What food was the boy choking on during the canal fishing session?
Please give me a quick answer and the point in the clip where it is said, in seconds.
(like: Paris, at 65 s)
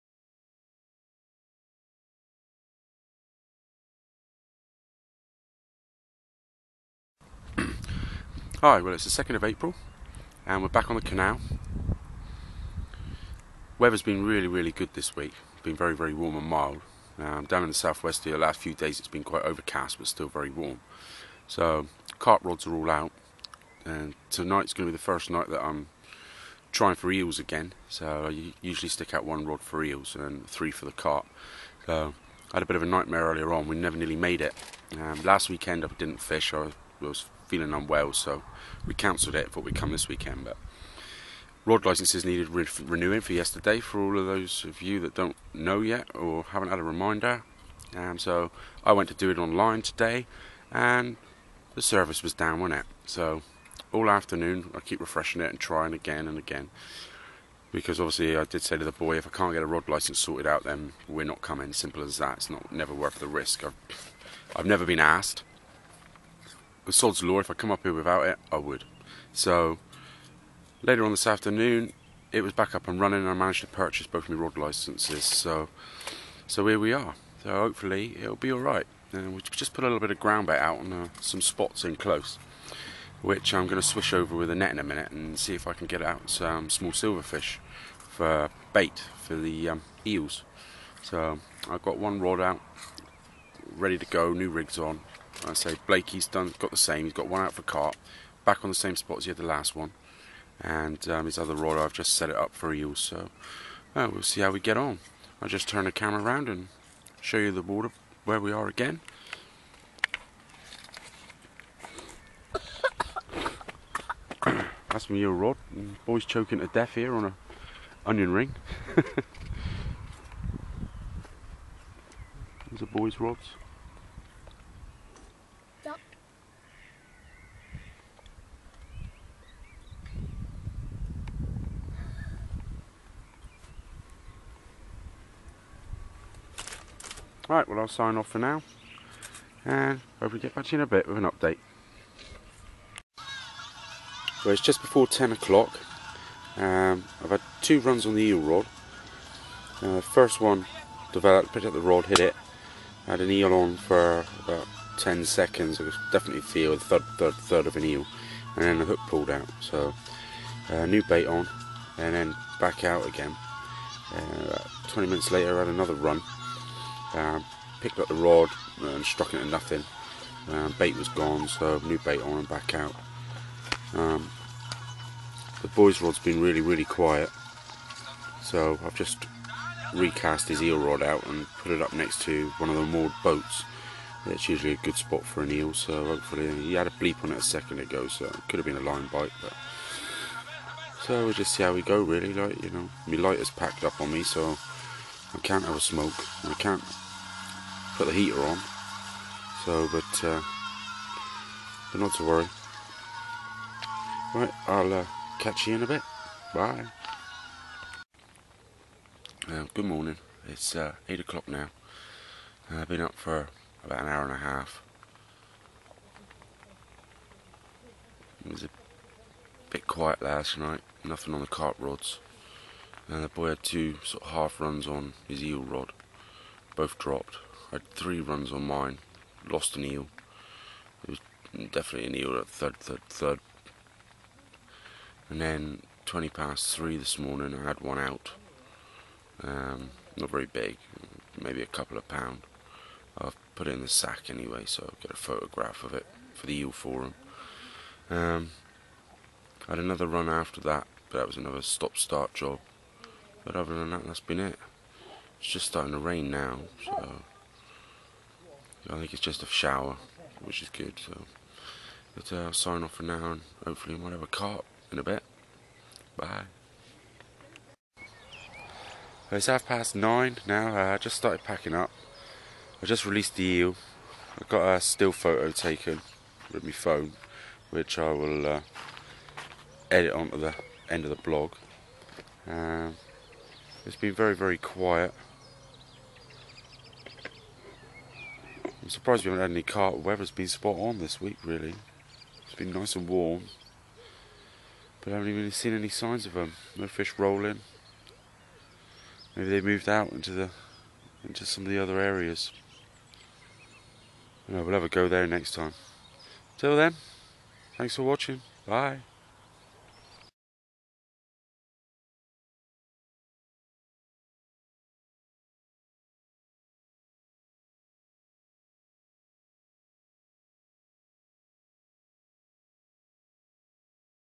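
onion ring, at 118 s.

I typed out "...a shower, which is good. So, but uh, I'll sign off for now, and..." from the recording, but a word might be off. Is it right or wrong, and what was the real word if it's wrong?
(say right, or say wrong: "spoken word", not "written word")
right.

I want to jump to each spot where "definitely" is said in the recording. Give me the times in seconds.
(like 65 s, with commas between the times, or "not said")
156 s, 231 s.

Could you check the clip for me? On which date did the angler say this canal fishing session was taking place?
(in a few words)
2nd of April.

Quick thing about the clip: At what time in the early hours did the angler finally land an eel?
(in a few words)
3:20.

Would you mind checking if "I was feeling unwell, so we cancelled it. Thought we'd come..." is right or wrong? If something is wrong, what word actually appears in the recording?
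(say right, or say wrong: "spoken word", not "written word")
right.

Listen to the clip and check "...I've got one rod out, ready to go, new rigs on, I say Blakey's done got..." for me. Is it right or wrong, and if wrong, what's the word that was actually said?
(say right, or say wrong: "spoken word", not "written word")
right.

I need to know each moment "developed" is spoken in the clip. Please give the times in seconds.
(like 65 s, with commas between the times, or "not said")
151 s.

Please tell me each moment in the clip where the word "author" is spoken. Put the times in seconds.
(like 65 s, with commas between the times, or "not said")
not said.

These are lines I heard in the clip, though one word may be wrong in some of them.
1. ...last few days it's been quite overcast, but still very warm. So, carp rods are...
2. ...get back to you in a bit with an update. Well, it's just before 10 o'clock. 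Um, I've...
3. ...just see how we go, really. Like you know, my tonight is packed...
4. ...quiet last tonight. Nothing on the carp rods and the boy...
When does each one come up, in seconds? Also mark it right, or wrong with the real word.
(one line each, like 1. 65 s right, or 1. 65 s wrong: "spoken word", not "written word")
1. 18 s right
2. 140 s right
3. 191 s wrong: "light", not "tonight"
4. 219 s wrong: "night", not "tonight".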